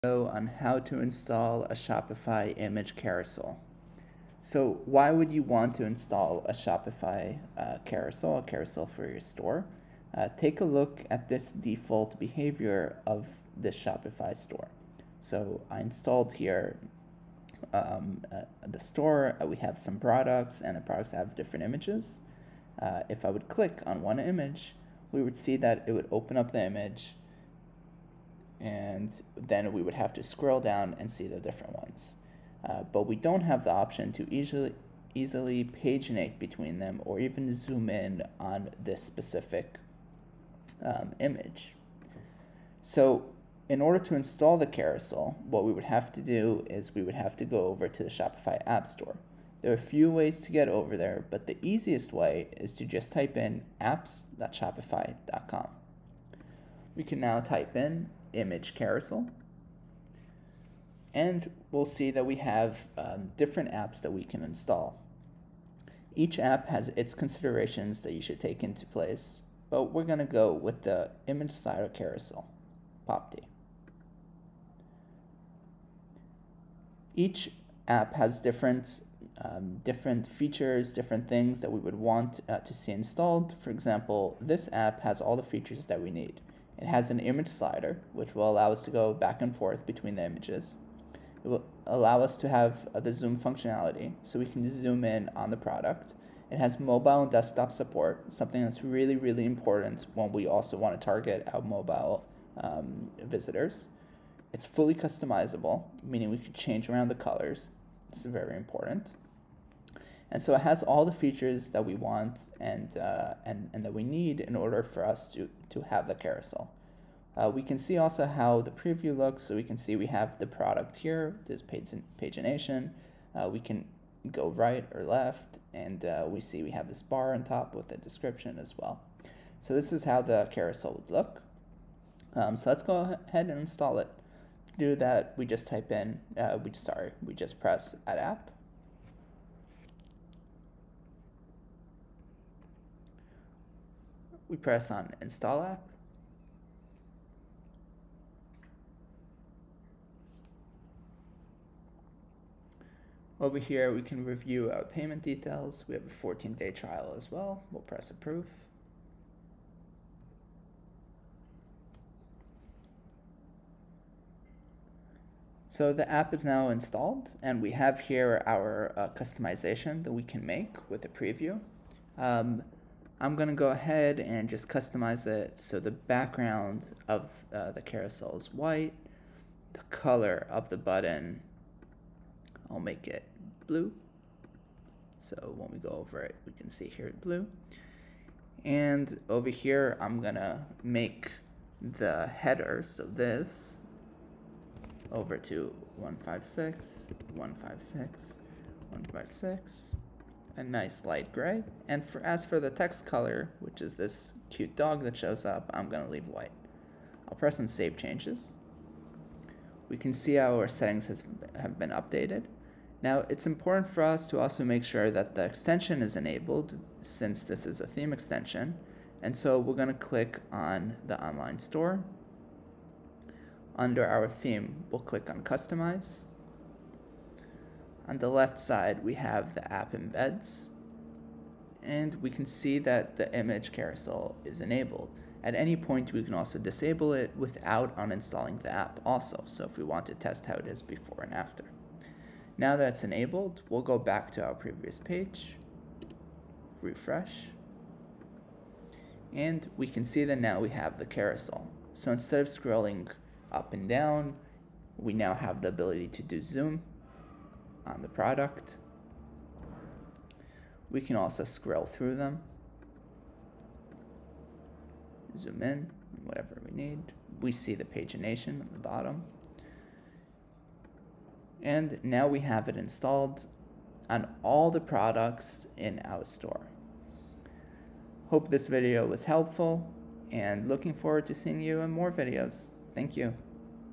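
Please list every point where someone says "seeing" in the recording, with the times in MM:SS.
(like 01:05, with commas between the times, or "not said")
04:41.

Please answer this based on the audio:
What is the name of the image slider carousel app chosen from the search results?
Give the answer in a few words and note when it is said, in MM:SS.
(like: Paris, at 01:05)
Popty, at 01:13.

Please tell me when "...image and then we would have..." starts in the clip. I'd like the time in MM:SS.
00:26.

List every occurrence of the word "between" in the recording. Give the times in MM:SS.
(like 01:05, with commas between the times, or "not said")
00:36, 01:29.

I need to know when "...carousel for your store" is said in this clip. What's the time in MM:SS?
00:08.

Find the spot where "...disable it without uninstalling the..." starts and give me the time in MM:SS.
03:56.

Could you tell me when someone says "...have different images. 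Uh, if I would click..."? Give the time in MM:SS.
00:21.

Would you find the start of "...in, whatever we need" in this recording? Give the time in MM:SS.
04:25.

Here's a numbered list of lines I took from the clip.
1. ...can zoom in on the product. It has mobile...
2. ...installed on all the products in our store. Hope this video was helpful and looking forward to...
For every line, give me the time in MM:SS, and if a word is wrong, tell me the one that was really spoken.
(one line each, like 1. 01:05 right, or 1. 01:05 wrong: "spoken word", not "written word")
1. 01:34 right
2. 04:32 right.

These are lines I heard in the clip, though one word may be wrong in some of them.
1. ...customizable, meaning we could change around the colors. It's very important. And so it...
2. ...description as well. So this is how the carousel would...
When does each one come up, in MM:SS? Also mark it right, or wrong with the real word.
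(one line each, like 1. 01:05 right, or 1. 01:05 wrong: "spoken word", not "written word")
1. 01:44 right
2. 02:07 right.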